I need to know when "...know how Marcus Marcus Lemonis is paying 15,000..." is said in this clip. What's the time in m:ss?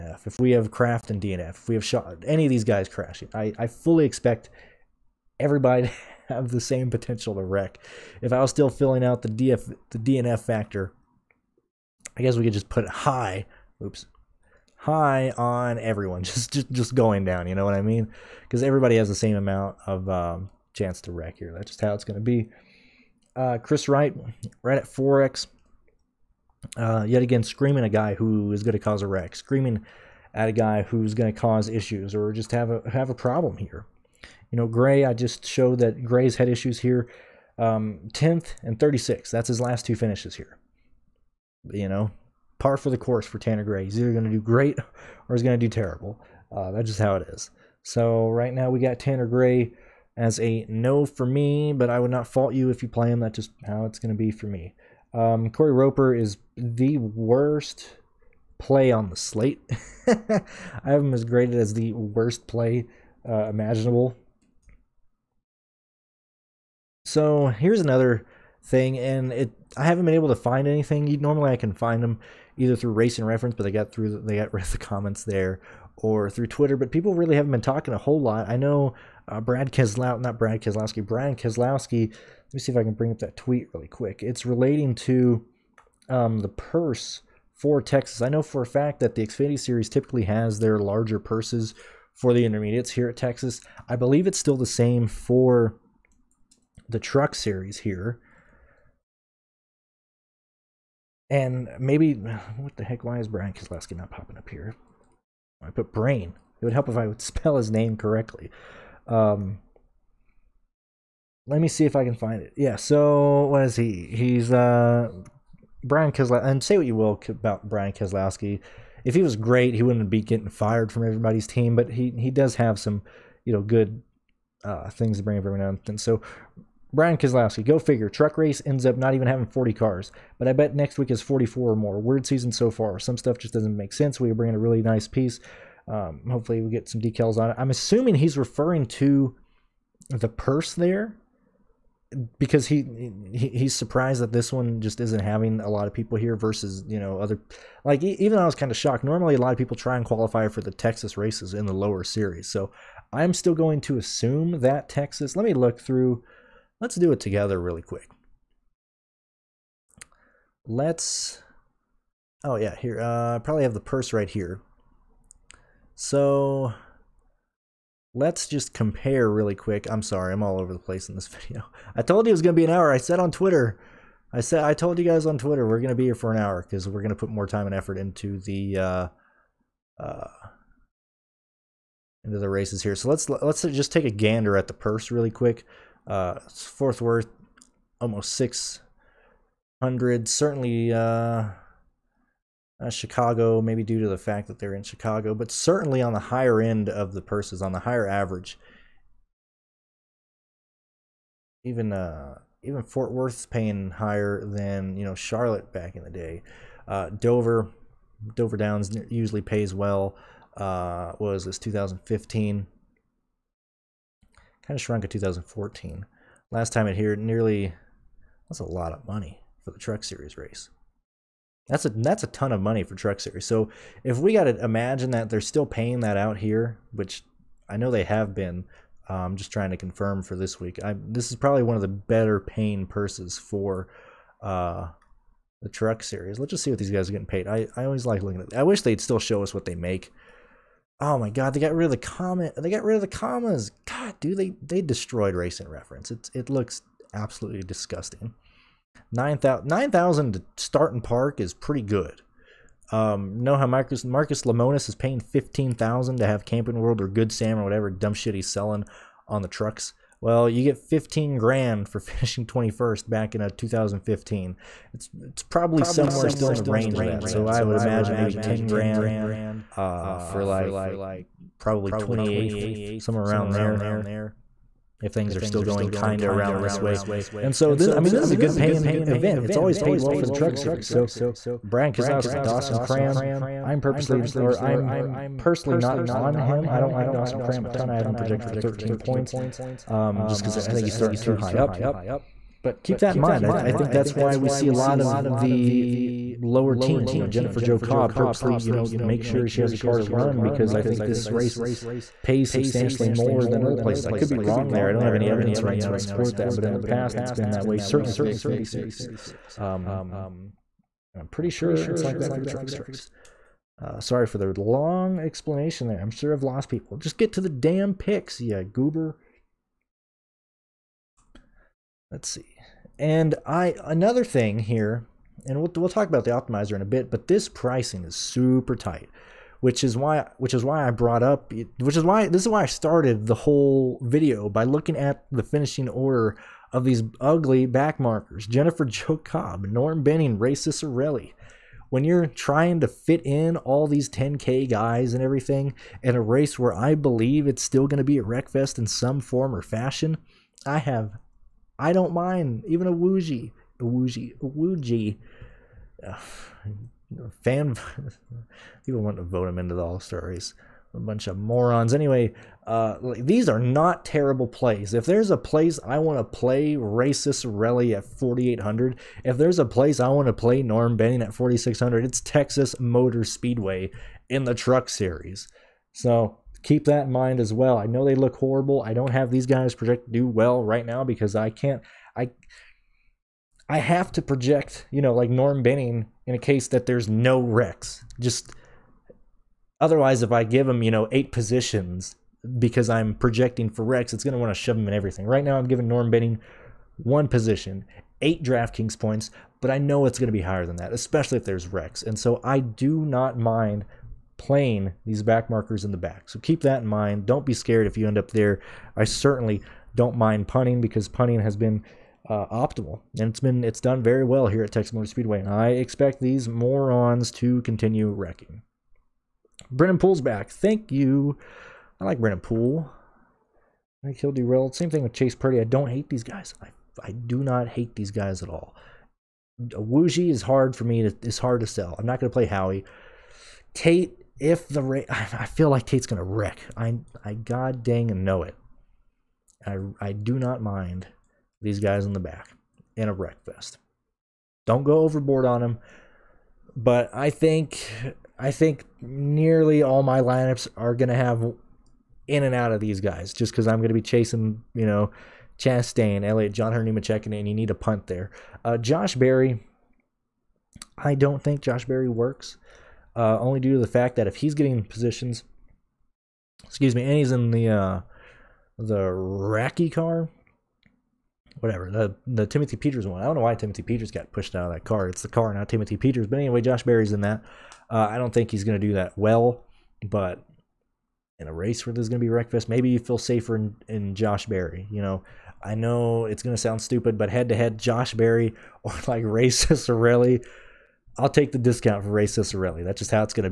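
4:13.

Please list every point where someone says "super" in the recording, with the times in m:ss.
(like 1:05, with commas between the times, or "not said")
5:28.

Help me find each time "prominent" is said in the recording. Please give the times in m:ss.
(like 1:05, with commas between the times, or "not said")
not said.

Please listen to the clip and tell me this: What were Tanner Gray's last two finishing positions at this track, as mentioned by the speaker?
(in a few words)
10th and 36th.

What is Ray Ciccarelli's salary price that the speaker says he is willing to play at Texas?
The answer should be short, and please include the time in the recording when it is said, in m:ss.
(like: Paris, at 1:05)
4,800, at 6:08.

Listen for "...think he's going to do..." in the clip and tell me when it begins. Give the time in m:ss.
7:58.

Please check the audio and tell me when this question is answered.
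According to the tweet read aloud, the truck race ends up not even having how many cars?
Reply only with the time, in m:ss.
2:09.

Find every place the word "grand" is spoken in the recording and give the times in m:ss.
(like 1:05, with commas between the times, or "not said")
4:21, 4:28.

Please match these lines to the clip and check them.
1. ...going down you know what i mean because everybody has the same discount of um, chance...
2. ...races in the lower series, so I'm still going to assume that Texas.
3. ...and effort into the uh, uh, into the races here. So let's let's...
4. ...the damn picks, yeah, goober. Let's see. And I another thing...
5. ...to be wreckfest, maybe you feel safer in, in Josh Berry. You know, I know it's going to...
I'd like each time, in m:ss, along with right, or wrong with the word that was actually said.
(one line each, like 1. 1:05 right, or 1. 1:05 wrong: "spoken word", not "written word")
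1. 0:16 wrong: "amount", not "discount"
2. 2:31 right
3. 2:57 right
4. 5:17 right
5. 8:02 right.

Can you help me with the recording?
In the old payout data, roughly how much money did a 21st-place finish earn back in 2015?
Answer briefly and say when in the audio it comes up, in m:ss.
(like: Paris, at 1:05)
15,000, at 4:20.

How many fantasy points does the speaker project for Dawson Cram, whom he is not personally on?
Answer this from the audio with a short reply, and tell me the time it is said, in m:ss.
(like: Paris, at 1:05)
13, at 4:48.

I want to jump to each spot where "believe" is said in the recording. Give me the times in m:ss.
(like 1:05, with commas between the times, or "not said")
1:33, 5:46.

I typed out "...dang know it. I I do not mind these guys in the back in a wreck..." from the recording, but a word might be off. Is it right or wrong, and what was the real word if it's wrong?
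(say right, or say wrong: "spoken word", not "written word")
right.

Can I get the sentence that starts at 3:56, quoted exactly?
Let's just see what these guys are getting paid.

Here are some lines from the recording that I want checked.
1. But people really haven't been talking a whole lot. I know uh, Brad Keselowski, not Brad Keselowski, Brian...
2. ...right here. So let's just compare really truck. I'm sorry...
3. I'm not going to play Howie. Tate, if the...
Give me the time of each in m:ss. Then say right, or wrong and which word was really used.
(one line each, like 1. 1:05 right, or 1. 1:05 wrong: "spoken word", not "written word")
1. 1:16 right
2. 2:44 wrong: "quick", not "truck"
3. 7:11 right.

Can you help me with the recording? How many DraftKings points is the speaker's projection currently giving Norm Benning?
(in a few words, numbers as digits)
8.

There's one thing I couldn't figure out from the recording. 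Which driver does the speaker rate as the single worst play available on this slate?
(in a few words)
Corey Roper.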